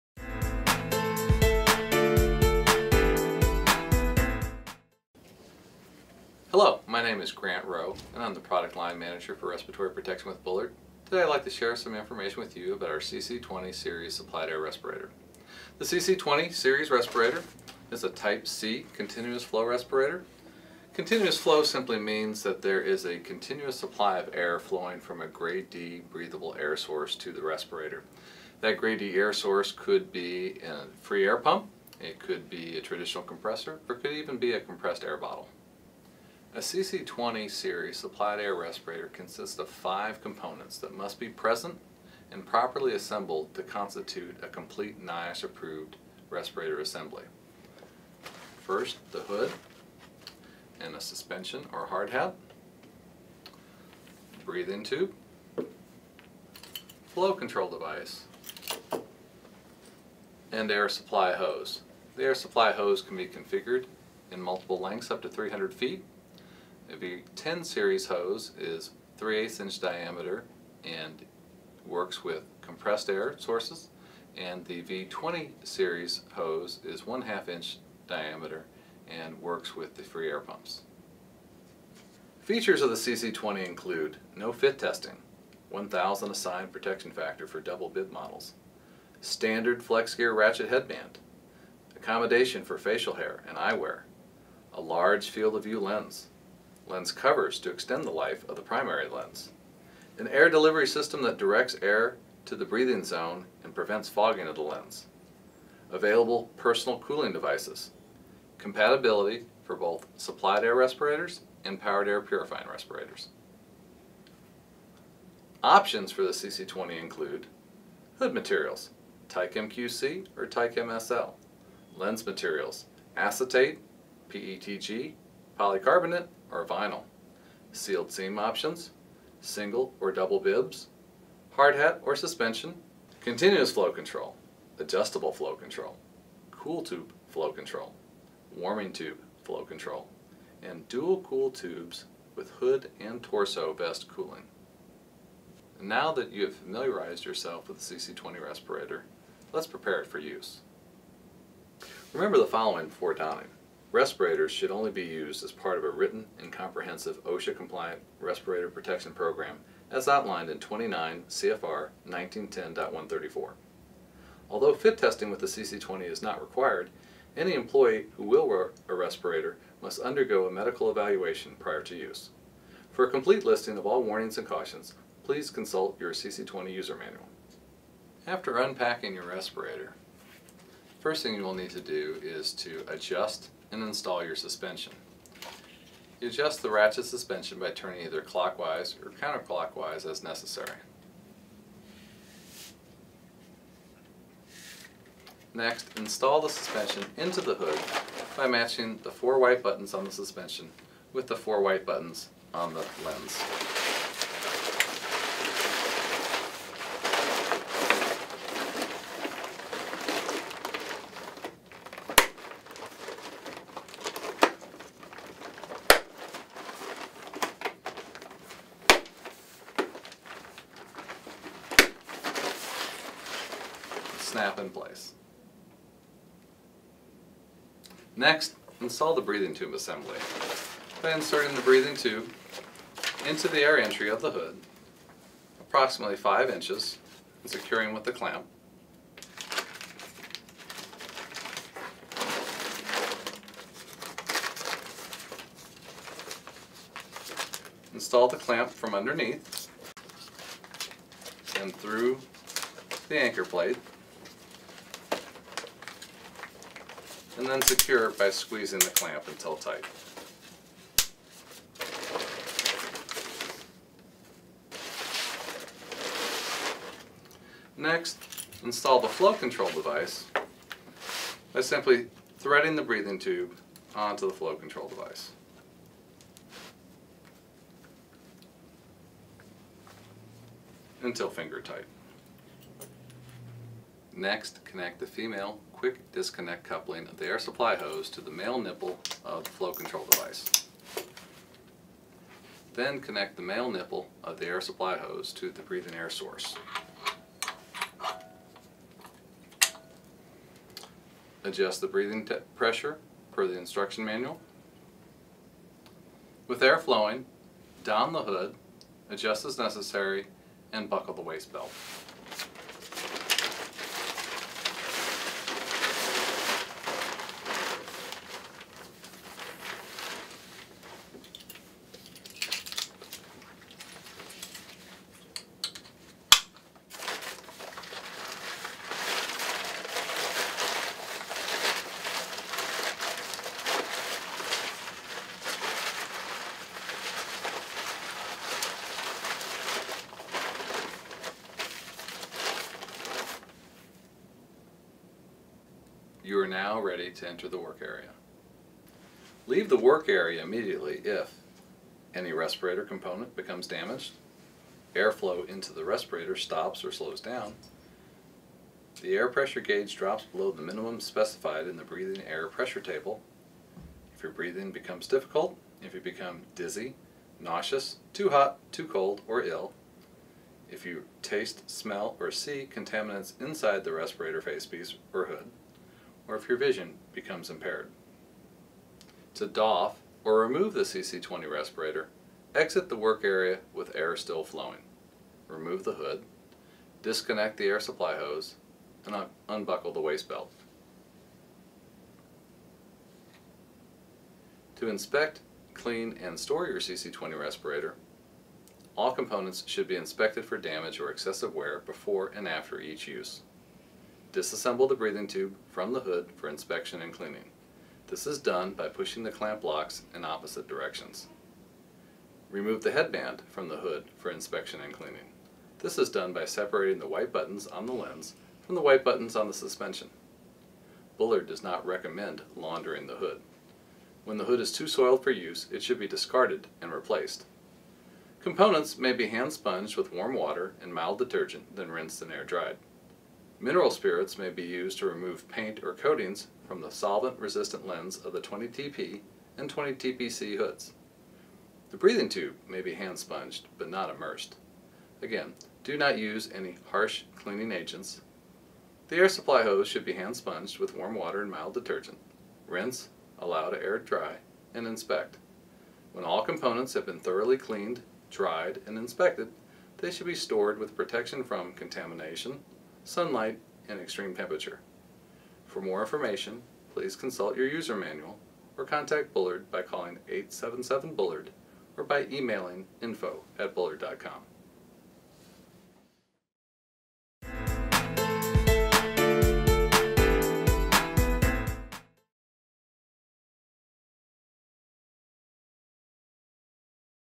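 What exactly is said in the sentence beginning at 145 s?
Now that you have familiarized yourself with the CC20 respirator, let's prepare it for use.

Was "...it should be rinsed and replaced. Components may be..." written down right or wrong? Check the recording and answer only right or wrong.
wrong.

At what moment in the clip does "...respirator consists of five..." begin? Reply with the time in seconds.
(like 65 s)
38 s.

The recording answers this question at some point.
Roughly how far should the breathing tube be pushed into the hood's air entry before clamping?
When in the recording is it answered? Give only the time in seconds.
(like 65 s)
236 s.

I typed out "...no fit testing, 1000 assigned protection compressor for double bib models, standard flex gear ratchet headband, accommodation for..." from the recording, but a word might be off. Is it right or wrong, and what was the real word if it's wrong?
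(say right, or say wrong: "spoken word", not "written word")
wrong: "factor", not "compressor".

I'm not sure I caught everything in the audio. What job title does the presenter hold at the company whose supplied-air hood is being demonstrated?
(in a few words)
Product Line Manager.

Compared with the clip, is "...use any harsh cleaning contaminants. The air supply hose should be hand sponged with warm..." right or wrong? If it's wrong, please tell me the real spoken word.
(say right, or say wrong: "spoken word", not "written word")
wrong: "agents", not "contaminants".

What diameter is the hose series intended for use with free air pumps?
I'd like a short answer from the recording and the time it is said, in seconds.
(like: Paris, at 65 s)
1/2 inch, at 77 s.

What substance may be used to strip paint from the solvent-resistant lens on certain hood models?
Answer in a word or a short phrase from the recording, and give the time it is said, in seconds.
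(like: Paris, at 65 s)
Mineral spirits, at 433 s.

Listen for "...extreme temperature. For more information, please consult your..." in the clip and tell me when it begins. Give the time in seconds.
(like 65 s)
463 s.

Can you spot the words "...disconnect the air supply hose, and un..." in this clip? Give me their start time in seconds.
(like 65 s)
387 s.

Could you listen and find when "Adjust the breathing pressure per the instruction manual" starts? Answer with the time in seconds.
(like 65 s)
301 s.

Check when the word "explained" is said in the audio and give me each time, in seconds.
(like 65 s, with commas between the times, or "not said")
not said.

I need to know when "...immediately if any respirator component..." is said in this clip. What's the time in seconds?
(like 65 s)
350 s.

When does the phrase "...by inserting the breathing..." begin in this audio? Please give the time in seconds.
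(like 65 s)
231 s.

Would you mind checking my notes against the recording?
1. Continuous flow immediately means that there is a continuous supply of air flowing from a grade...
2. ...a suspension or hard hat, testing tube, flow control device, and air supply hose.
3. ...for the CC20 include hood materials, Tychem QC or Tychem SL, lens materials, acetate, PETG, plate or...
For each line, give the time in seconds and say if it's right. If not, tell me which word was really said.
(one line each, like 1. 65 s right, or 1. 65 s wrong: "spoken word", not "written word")
1. 20 s wrong: "simply", not "immediately"
2. 50 s wrong: "breathing", not "testing"
3. 116 s wrong: "polycarbonate", not "plate".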